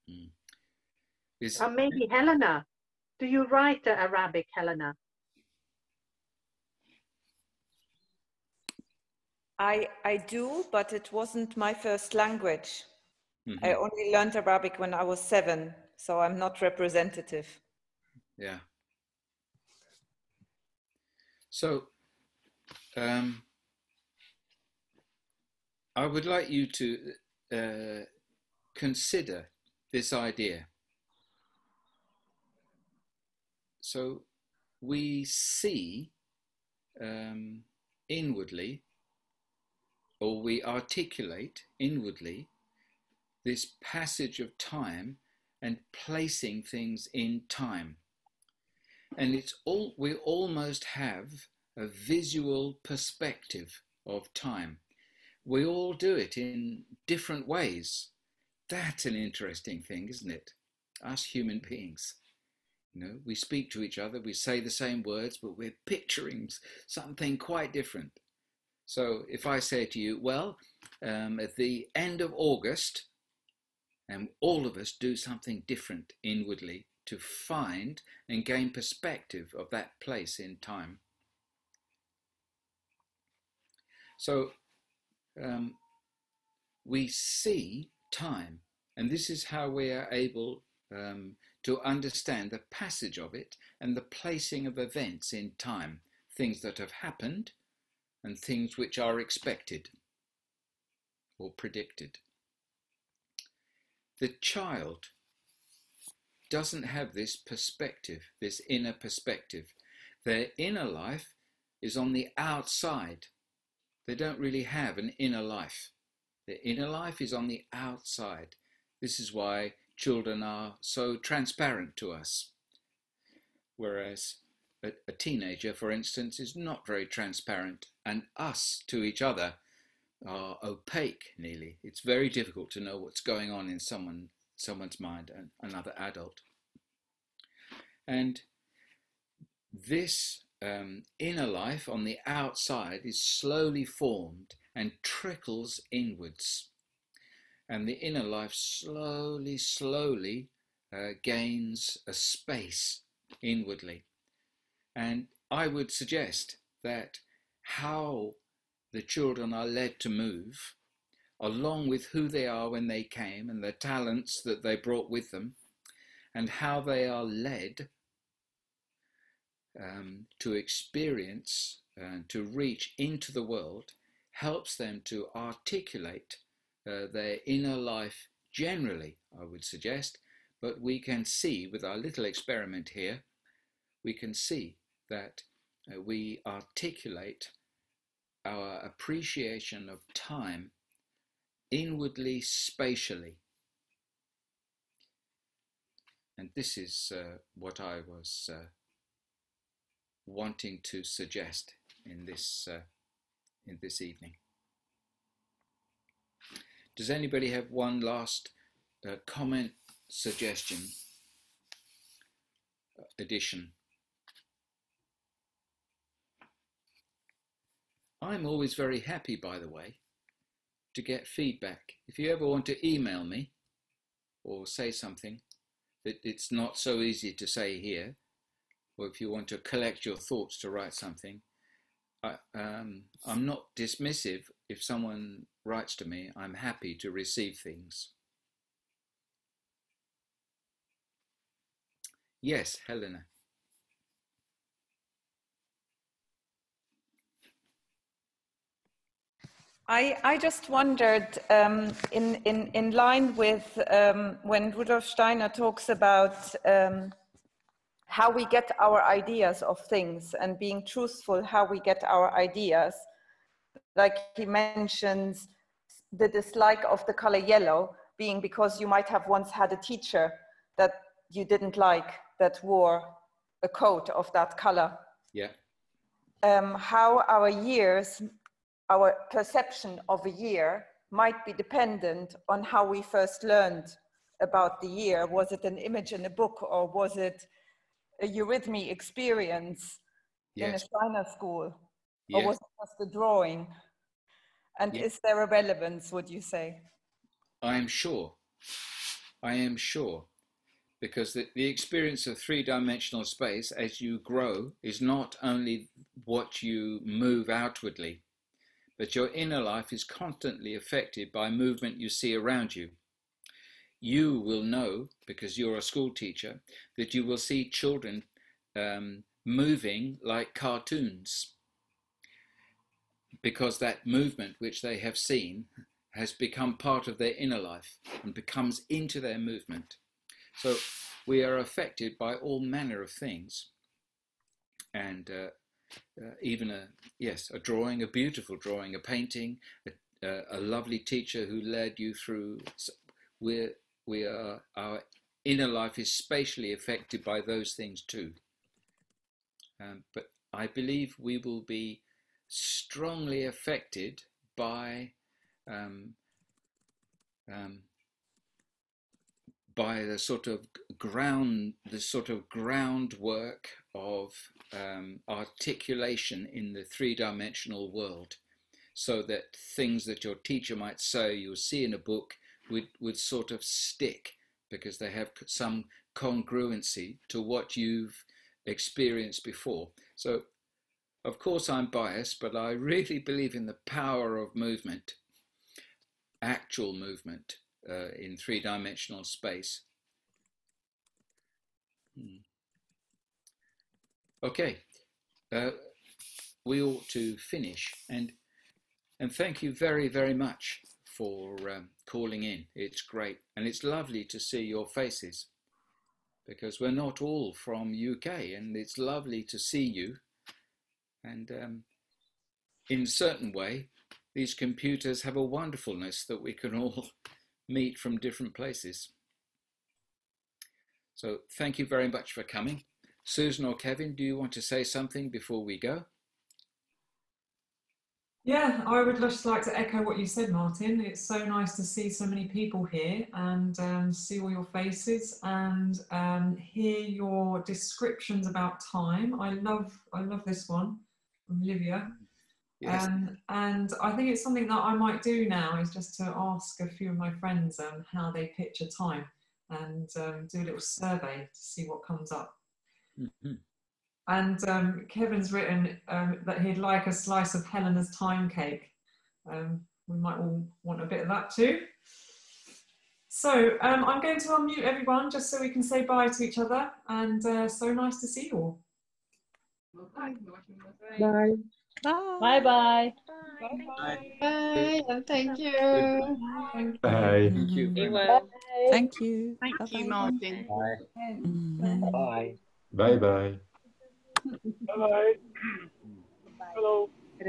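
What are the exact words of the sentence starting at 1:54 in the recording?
They don't really have an inner life.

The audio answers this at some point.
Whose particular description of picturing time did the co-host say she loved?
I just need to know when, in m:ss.
7:21.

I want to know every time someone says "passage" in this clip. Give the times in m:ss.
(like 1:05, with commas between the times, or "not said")
0:43, 1:32.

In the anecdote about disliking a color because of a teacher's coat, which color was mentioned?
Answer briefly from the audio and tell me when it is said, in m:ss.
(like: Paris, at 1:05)
Yellow, at 4:27.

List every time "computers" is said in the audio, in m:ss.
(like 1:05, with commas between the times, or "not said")
6:54.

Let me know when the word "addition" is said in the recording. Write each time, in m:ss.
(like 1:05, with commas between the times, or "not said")
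3:33.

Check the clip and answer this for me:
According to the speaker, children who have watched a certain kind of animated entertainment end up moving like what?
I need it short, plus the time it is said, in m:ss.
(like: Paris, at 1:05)
Cartoons, at 5:20.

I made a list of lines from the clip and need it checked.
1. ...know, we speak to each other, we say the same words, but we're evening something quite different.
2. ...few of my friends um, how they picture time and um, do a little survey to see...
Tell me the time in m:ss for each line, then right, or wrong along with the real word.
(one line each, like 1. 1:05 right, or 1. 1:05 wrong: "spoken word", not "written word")
1. 1:03 wrong: "picturing", not "evening"
2. 7:26 right.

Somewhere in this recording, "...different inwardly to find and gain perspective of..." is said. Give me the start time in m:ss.
1:15.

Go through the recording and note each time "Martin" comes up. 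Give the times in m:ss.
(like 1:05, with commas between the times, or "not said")
7:10, 8:00.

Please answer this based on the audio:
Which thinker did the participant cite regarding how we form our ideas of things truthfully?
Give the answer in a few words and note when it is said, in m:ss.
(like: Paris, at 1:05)
Rudolf Steiner, at 4:14.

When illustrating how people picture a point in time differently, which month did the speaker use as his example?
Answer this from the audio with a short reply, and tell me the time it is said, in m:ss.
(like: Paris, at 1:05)
August, at 1:12.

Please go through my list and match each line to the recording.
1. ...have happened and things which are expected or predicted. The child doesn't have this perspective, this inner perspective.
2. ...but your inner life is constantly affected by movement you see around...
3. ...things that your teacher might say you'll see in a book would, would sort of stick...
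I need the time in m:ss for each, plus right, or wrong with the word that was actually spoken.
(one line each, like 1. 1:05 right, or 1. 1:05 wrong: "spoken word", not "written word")
1. 1:36 right
2. 5:08 right
3. 6:09 right.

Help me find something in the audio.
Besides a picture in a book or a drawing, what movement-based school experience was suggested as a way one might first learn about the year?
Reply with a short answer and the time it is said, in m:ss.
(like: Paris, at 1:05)
Eurythmy, at 4:48.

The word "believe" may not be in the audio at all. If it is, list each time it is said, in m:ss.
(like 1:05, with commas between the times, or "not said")
5:50, 6:23.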